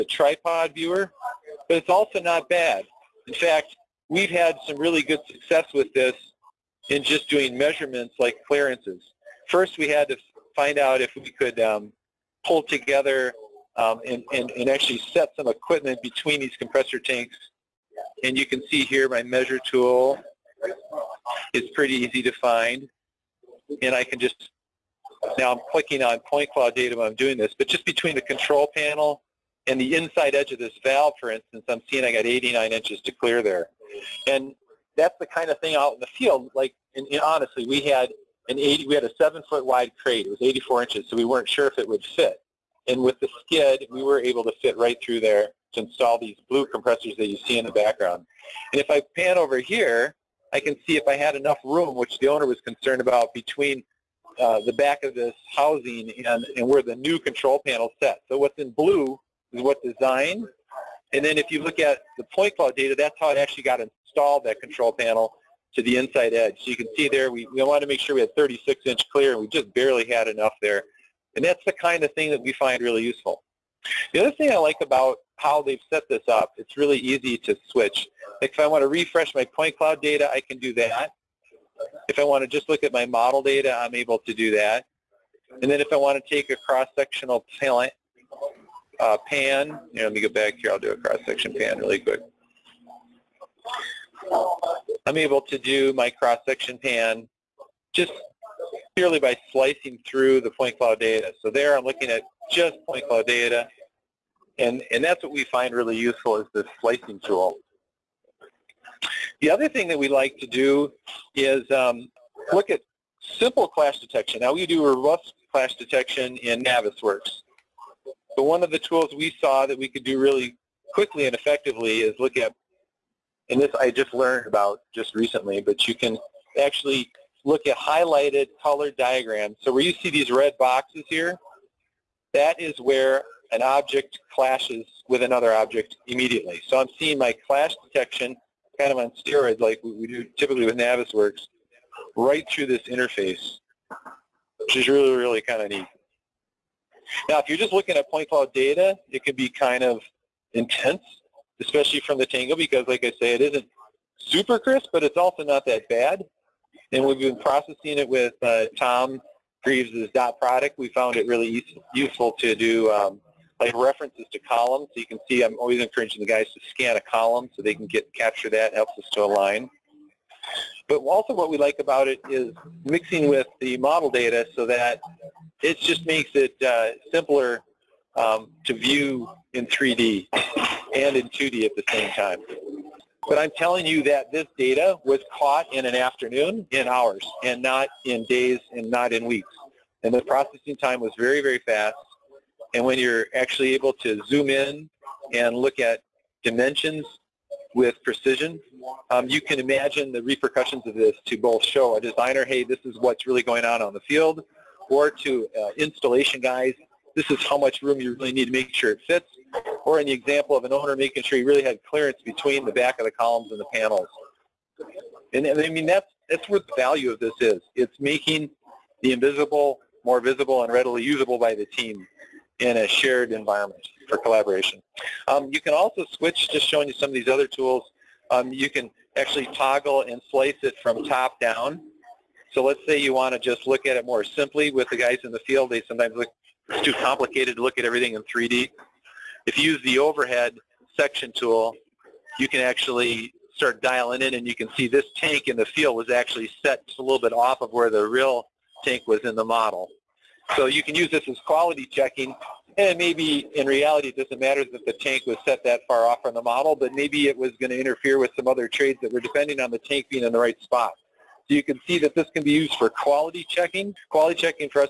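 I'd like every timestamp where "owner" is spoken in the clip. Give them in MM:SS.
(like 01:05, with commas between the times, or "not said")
00:52, 03:30.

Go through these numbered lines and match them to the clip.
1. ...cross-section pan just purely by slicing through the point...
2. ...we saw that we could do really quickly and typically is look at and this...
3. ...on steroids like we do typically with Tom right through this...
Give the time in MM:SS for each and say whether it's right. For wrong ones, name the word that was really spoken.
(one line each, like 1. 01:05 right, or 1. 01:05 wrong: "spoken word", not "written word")
1. 01:36 right
2. 01:59 wrong: "effectively", not "typically"
3. 02:18 wrong: "Navisworks", not "Tom".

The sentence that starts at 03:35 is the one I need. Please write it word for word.
And, and I mean, that's, that's where the value of this is.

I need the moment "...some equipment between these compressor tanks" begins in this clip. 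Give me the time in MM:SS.
00:15.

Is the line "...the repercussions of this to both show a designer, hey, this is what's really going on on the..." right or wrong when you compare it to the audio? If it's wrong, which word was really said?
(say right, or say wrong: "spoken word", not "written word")
right.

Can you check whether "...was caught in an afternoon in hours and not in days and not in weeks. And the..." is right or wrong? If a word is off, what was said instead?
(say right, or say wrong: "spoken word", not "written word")
right.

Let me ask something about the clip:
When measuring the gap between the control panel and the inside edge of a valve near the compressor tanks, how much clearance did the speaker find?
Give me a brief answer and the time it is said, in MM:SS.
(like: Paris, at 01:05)
89 inches, at 00:32.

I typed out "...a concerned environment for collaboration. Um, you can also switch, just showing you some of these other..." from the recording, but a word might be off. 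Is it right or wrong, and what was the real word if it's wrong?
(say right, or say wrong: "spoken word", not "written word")
wrong: "shared", not "concerned".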